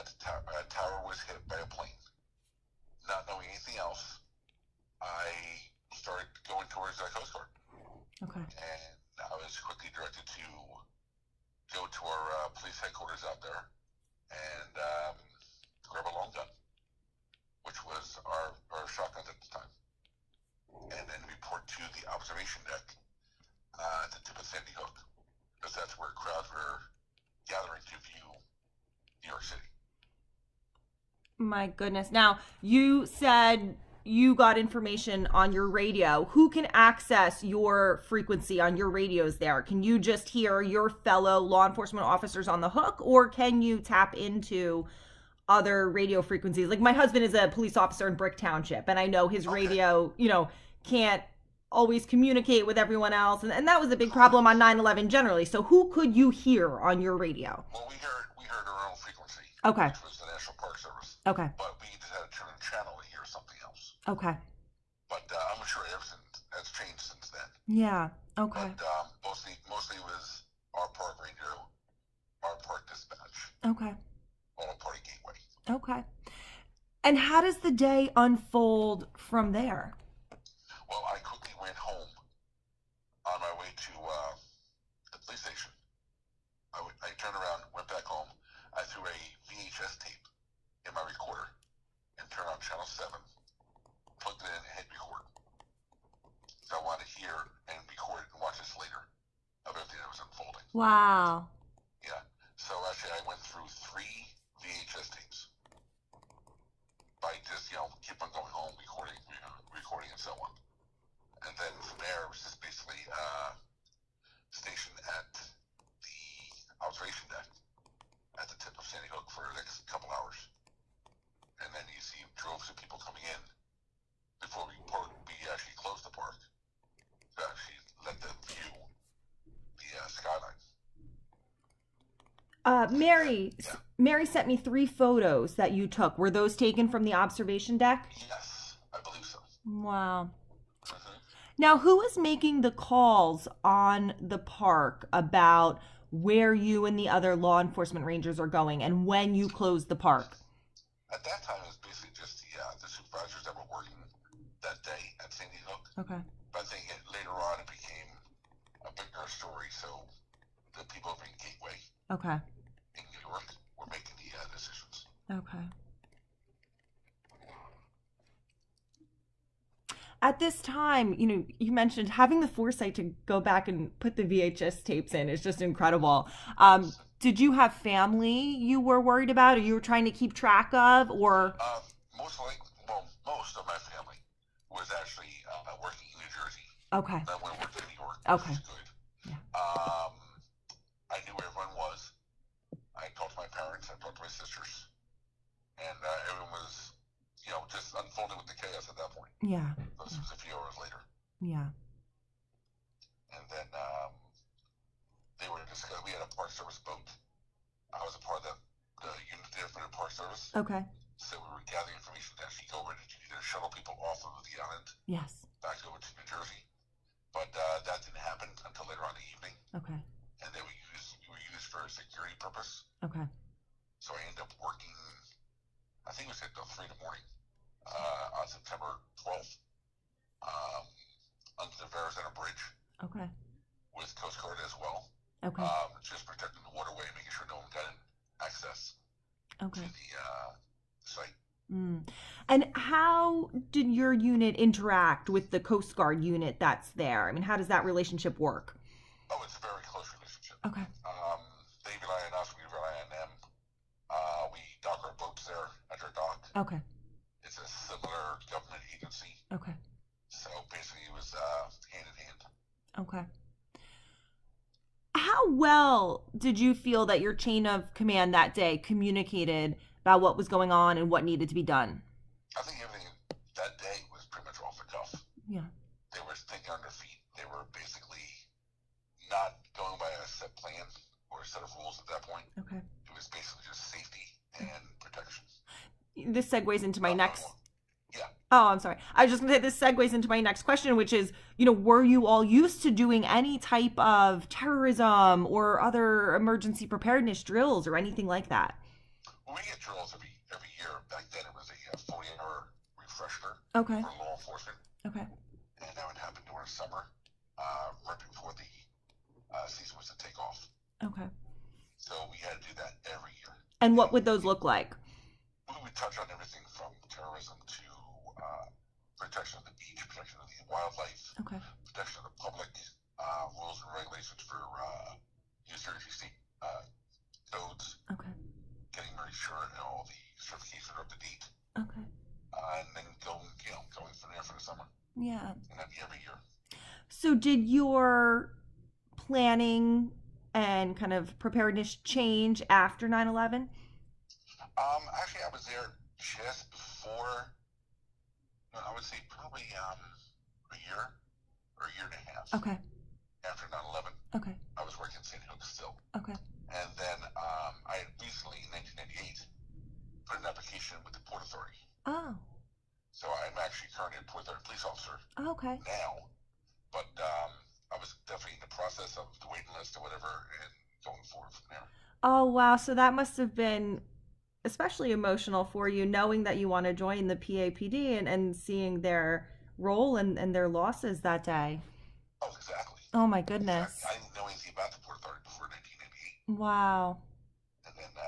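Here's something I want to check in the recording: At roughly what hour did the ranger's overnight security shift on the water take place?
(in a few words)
3 in the morning.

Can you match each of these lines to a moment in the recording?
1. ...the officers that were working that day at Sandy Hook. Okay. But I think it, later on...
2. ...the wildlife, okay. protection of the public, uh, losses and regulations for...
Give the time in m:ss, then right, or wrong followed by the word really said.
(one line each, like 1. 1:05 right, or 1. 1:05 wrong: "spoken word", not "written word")
1. 2:32 wrong: "supervisors", not "officers"
2. 5:20 wrong: "rules", not "losses".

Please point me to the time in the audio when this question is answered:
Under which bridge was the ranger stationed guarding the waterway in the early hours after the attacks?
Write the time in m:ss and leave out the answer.
3:51.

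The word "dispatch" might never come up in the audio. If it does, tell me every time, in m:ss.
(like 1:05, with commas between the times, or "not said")
1:12.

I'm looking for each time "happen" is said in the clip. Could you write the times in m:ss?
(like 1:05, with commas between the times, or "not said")
3:38, 5:06.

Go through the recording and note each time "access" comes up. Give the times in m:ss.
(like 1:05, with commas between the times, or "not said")
0:36, 3:58.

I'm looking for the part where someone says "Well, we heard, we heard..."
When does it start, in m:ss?
0:57.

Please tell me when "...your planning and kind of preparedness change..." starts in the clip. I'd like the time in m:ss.
5:37.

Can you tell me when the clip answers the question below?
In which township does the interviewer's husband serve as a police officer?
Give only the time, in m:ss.
0:48.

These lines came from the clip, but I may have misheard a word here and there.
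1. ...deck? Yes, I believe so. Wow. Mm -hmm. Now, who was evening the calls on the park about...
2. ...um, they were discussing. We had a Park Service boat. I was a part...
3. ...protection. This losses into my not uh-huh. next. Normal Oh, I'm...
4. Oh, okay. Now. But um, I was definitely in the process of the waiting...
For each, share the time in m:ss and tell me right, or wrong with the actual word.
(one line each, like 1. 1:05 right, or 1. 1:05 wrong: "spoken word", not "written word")
1. 2:17 wrong: "making", not "evening"
2. 3:23 right
3. 4:44 wrong: "segues", not "losses"
4. 6:05 right.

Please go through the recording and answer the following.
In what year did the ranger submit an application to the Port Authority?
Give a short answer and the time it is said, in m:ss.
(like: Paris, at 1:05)
1998, at 5:58.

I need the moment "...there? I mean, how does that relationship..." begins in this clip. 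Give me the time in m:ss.
4:06.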